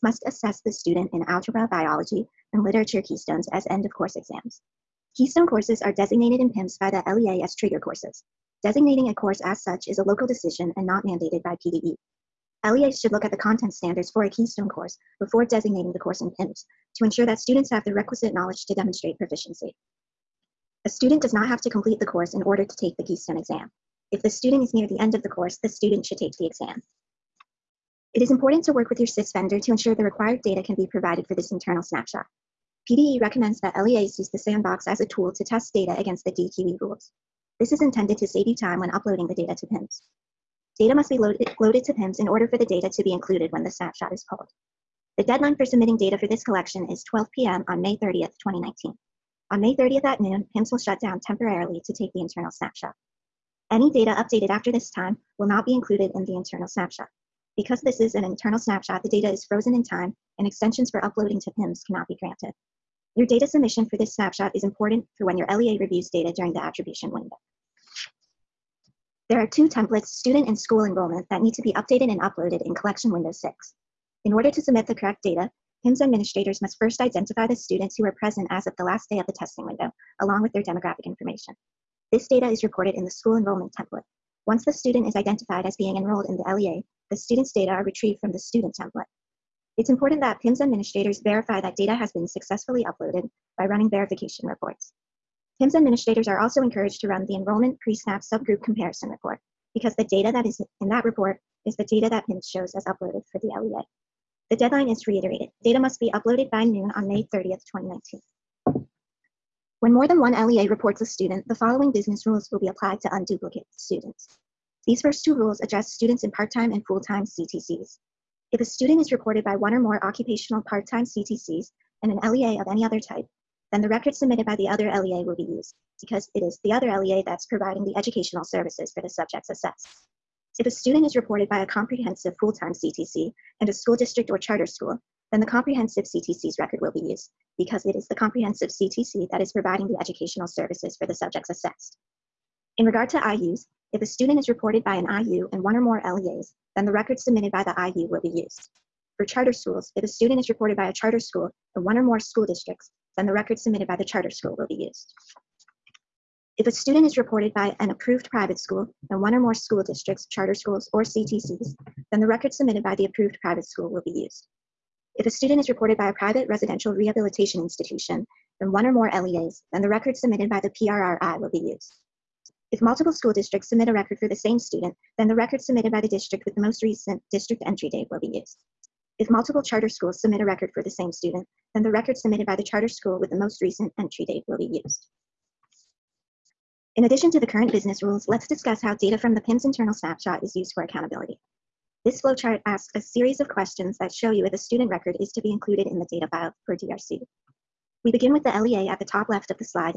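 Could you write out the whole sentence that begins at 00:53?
Any data updated after this time will not be included in the internal snapshot.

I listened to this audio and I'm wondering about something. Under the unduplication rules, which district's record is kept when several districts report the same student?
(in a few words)
most recent district entry date.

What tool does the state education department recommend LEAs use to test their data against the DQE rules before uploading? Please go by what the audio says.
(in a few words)
sandbox.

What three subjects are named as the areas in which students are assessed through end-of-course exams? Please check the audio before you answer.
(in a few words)
algebra, biology, and literature.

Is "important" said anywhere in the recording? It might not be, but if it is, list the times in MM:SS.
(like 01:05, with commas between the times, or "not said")
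00:28, 01:04, 01:29.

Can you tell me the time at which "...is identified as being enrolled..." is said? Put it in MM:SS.
01:25.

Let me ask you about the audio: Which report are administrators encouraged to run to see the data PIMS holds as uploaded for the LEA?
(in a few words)
enrollment pre-SNAP subgroup comparison report.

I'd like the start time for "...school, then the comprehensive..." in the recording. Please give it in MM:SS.
02:14.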